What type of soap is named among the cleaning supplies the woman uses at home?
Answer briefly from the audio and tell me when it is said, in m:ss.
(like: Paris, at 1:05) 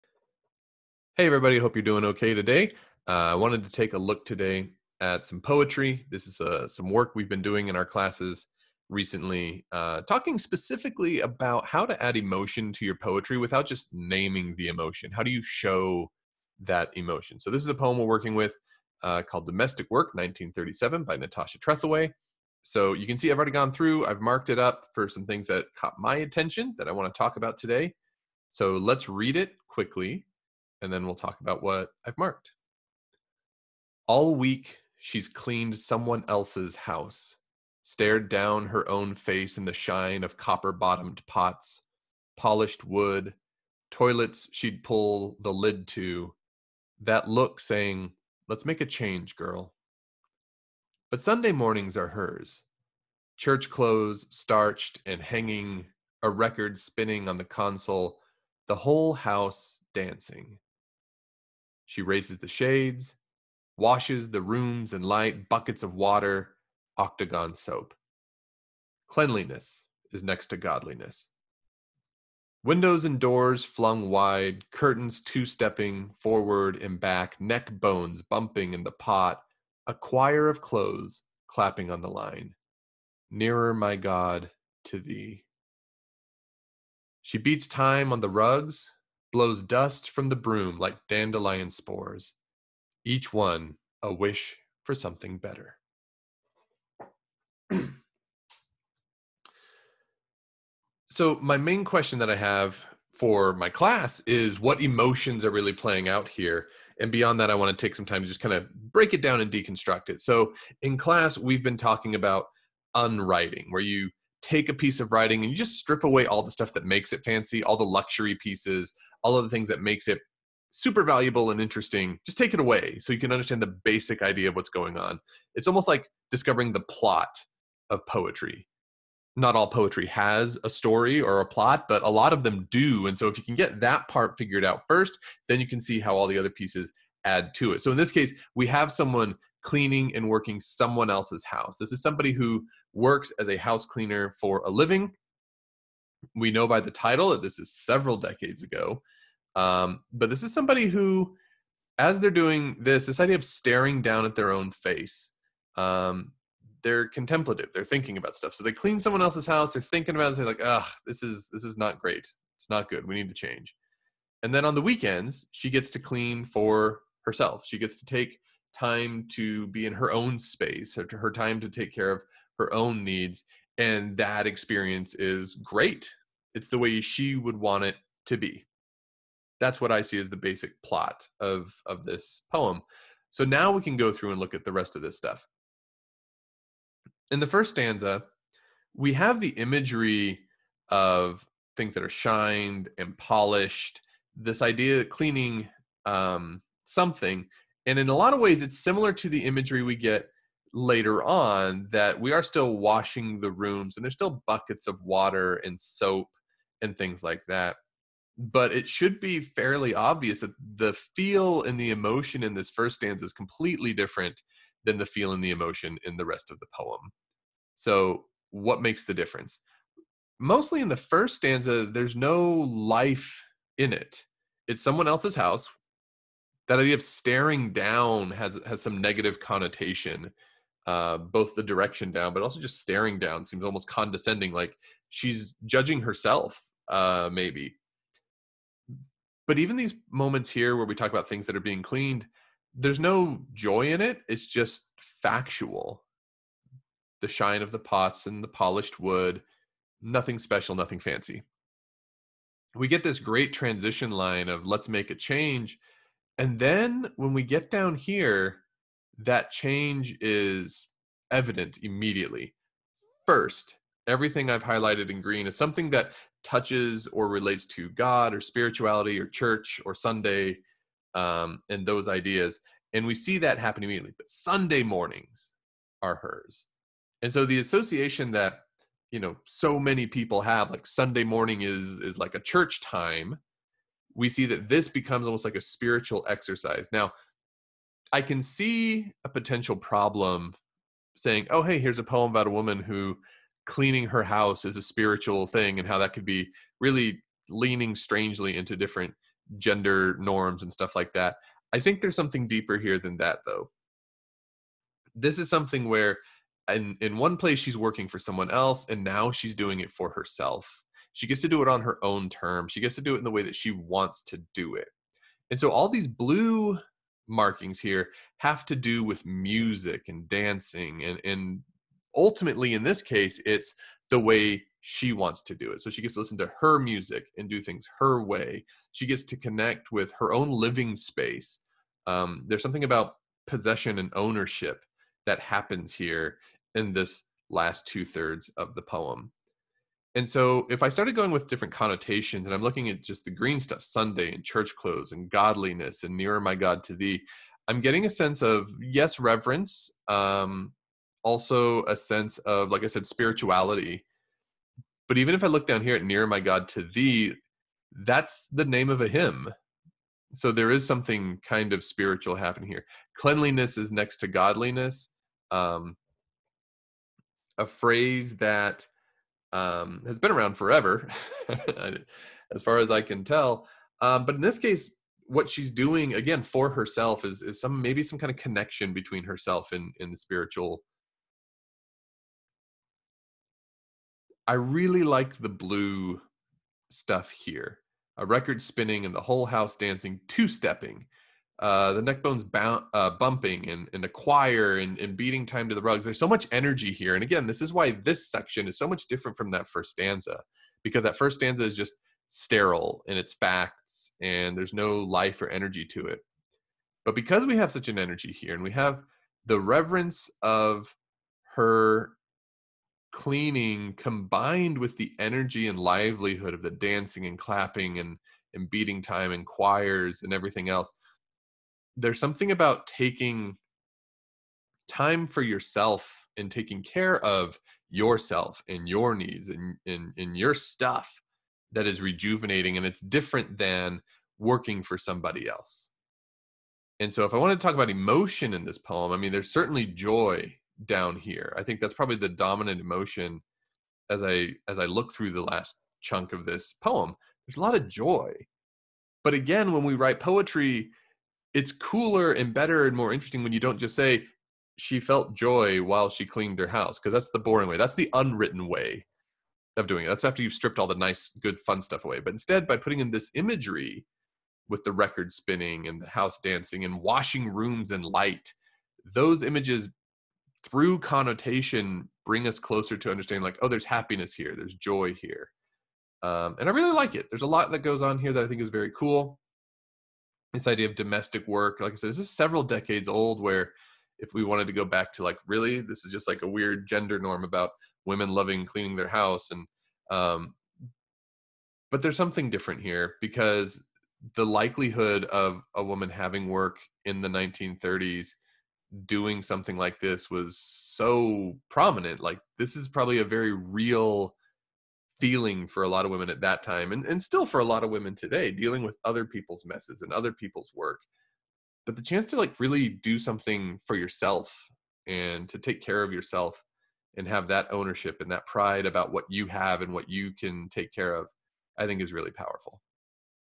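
octagon soap, at 1:06.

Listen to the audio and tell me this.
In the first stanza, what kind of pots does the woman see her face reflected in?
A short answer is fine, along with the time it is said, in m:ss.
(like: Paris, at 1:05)
copper bottomed pots, at 0:40.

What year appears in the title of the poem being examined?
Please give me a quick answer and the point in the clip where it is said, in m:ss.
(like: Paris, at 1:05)
1937, at 0:20.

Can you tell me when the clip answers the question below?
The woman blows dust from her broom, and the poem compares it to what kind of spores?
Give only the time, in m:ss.
1:31.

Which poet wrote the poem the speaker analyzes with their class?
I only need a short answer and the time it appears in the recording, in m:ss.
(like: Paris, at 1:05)
Natasha Trethewey, at 0:21.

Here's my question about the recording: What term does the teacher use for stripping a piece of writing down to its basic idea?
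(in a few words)
unwriting.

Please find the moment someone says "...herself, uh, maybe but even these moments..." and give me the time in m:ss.
3:56.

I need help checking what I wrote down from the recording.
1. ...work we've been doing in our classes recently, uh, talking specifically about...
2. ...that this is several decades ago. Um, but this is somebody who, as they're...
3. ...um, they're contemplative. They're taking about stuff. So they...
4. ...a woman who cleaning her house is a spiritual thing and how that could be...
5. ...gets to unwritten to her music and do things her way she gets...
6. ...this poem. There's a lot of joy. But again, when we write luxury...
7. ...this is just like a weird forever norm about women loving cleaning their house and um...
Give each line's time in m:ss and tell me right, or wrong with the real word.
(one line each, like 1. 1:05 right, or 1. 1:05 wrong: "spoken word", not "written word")
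1. 0:06 right
2. 2:27 right
3. 2:35 wrong: "thinking", not "taking"
4. 4:52 right
5. 5:26 wrong: "listen", not "unwritten"
6. 7:26 wrong: "poetry", not "luxury"
7. 8:05 wrong: "gender", not "forever".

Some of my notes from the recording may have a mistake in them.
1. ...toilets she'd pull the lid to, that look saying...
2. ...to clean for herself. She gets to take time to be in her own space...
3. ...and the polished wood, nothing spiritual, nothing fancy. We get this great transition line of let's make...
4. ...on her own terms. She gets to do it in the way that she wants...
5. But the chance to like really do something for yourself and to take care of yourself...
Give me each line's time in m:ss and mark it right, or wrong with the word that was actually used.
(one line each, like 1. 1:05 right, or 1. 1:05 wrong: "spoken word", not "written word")
1. 0:43 right
2. 2:45 right
3. 4:08 wrong: "special", not "spiritual"
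4. 5:11 right
5. 8:31 right.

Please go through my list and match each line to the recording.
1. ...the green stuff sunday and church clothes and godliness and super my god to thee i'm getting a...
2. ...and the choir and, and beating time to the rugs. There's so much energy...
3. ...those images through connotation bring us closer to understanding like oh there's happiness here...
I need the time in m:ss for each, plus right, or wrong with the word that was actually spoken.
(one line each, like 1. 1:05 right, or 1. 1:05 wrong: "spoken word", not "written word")
1. 5:43 wrong: "nearer", not "super"
2. 6:33 right
3. 7:49 right.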